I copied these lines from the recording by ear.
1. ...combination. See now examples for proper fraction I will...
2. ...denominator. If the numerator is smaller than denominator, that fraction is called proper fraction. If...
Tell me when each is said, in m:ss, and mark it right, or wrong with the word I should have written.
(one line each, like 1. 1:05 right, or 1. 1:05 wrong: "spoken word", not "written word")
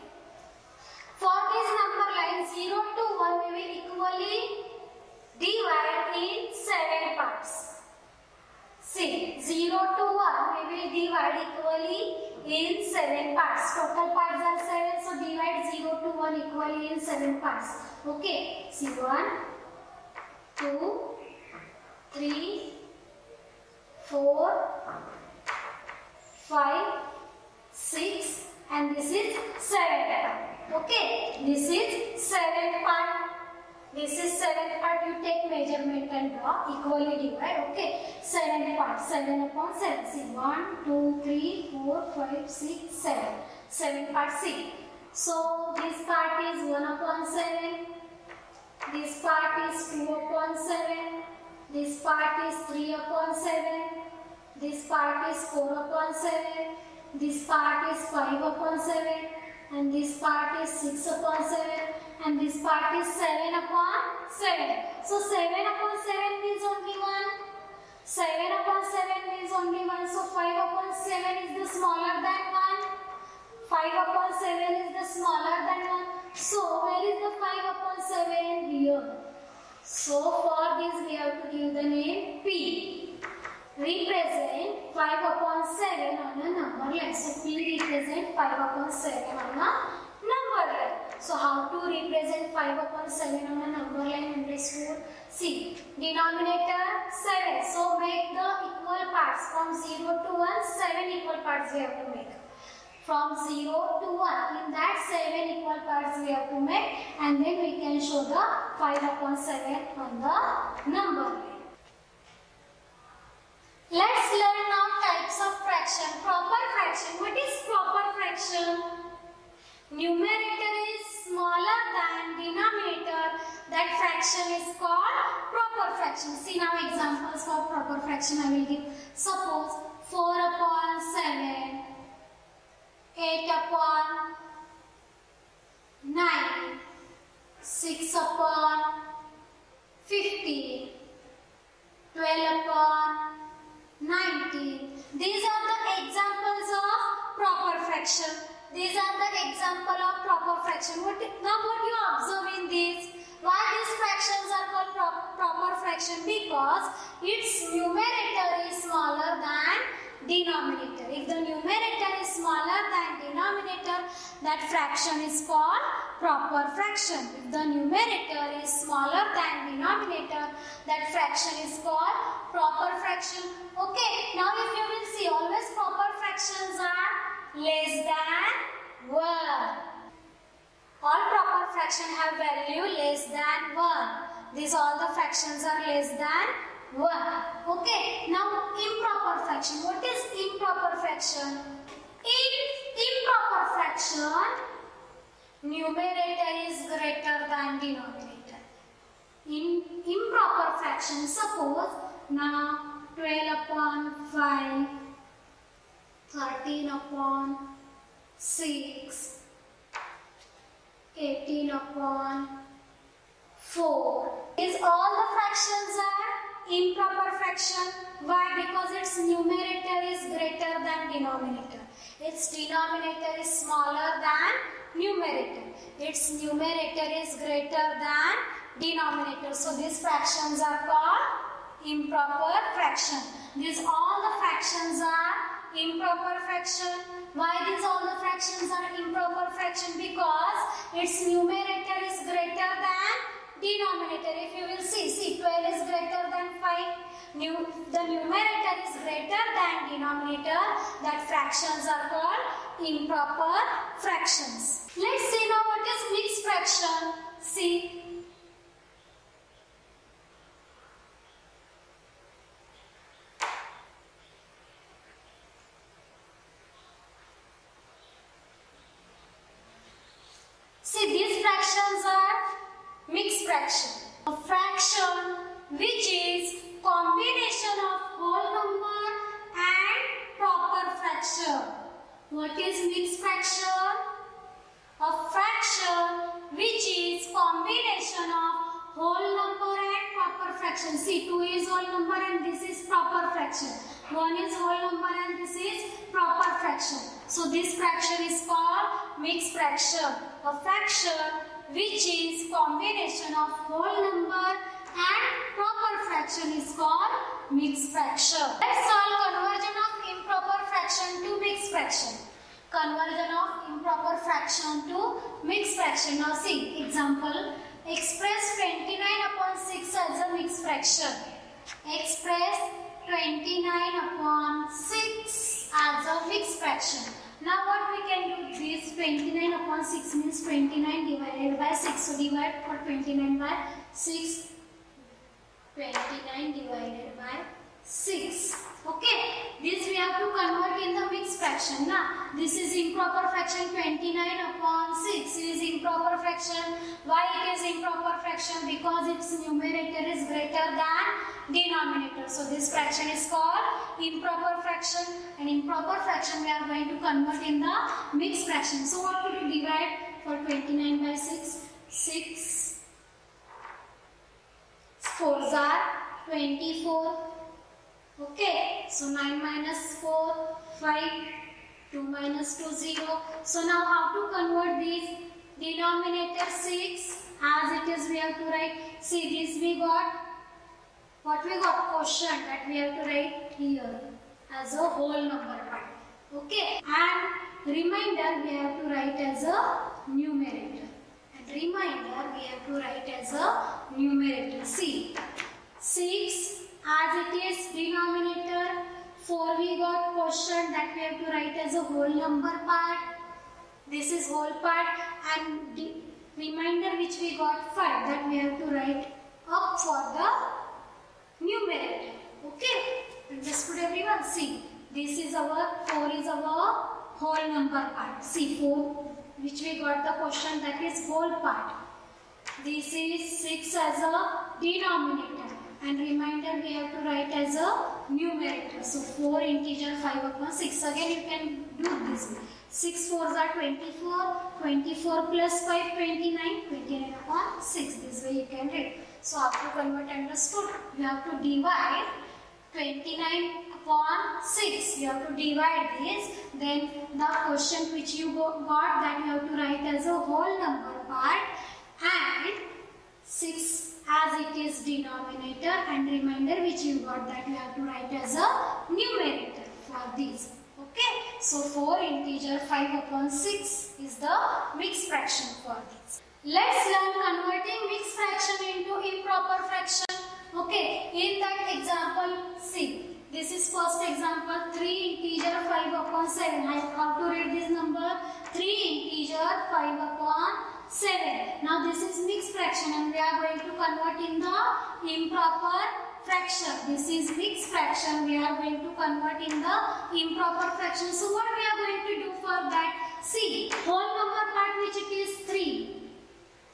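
1. 2:05 wrong: "fraction", not "combination"
2. 2:40 right.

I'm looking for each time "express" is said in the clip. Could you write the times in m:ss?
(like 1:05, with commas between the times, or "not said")
5:17, 5:21.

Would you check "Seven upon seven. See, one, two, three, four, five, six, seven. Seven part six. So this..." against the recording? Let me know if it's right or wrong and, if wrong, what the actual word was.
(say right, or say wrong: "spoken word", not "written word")
right.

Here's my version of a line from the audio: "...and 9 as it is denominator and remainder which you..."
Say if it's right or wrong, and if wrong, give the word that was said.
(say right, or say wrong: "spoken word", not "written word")
wrong: "6", not "9".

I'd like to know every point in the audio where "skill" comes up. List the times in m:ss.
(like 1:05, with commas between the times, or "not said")
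not said.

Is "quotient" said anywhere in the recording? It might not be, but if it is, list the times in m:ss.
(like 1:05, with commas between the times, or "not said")
6:21, 6:40, 7:00, 7:27.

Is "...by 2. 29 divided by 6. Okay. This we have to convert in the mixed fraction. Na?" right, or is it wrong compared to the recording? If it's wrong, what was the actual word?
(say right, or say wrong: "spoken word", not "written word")
wrong: "6", not "2".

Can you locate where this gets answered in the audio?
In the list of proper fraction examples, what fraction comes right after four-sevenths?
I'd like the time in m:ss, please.
2:13.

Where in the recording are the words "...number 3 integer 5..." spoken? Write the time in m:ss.
7:57.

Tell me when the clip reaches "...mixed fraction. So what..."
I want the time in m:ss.
5:58.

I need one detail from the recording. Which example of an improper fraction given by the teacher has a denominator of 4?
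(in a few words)
18/4.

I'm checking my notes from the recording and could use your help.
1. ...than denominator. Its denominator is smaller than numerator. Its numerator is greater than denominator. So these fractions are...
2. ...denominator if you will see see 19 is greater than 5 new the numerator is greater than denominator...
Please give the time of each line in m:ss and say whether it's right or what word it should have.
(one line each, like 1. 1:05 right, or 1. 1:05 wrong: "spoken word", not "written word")
1. 3:40 right
2. 4:03 wrong: "12", not "19".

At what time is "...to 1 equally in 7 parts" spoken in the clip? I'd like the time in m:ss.
0:16.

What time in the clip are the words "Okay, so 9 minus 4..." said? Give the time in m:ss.
6:08.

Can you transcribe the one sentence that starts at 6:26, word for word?
Okay, and remainder we have to write as a numerator.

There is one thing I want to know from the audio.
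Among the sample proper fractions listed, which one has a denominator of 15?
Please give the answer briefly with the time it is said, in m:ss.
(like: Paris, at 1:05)
6/15, at 2:17.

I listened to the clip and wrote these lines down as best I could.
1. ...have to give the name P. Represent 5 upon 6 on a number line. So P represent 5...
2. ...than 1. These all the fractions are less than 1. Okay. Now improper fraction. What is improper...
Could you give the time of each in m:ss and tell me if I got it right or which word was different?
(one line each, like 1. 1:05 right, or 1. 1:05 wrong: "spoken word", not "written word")
1. 1:21 wrong: "7", not "6"
2. 3:03 right.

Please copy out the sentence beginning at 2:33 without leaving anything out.
Why these fractions are called pro proper fraction?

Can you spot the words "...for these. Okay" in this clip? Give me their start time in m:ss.
7:39.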